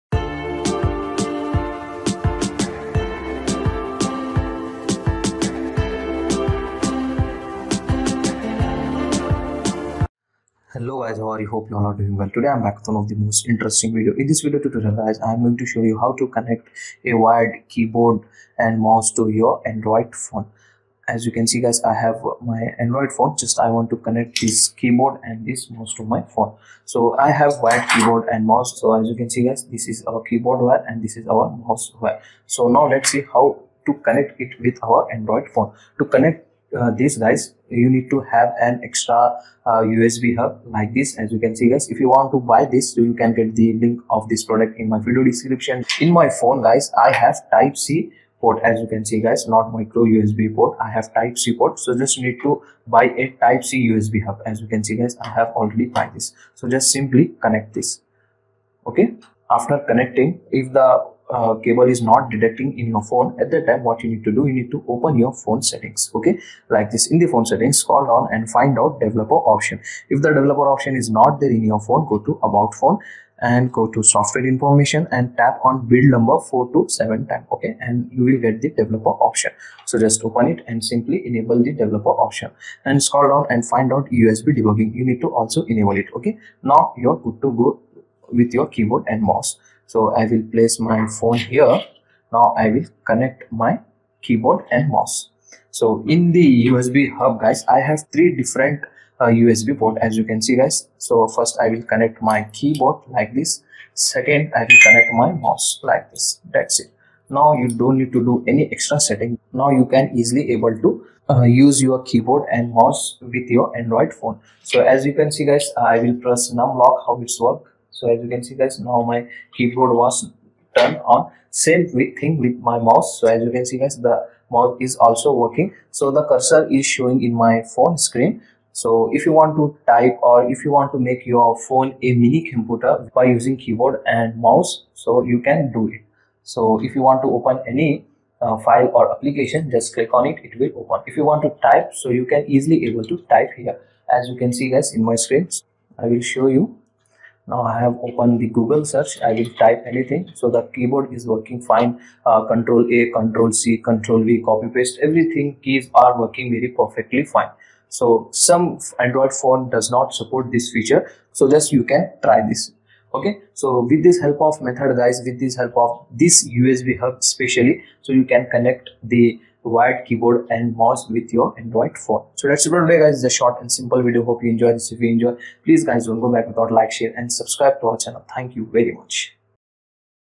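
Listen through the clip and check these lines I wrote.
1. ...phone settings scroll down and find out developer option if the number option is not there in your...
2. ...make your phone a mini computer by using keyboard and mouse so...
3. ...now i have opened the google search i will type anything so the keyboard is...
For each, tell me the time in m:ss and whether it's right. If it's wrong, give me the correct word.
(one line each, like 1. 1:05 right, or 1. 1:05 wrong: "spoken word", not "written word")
1. 1:07 wrong: "developer", not "number"
2. 2:10 right
3. 2:27 right.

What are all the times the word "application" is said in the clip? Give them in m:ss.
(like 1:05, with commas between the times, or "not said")
2:19.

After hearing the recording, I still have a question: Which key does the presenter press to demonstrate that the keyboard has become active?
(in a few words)
num lock.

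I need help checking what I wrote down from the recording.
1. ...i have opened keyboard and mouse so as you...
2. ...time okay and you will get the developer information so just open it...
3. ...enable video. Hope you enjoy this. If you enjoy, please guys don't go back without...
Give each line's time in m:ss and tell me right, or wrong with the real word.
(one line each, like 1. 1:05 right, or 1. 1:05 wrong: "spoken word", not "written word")
1. 0:27 wrong: "wired", not "opened"
2. 1:17 wrong: "option", not "information"
3. 2:53 wrong: "simple", not "enable".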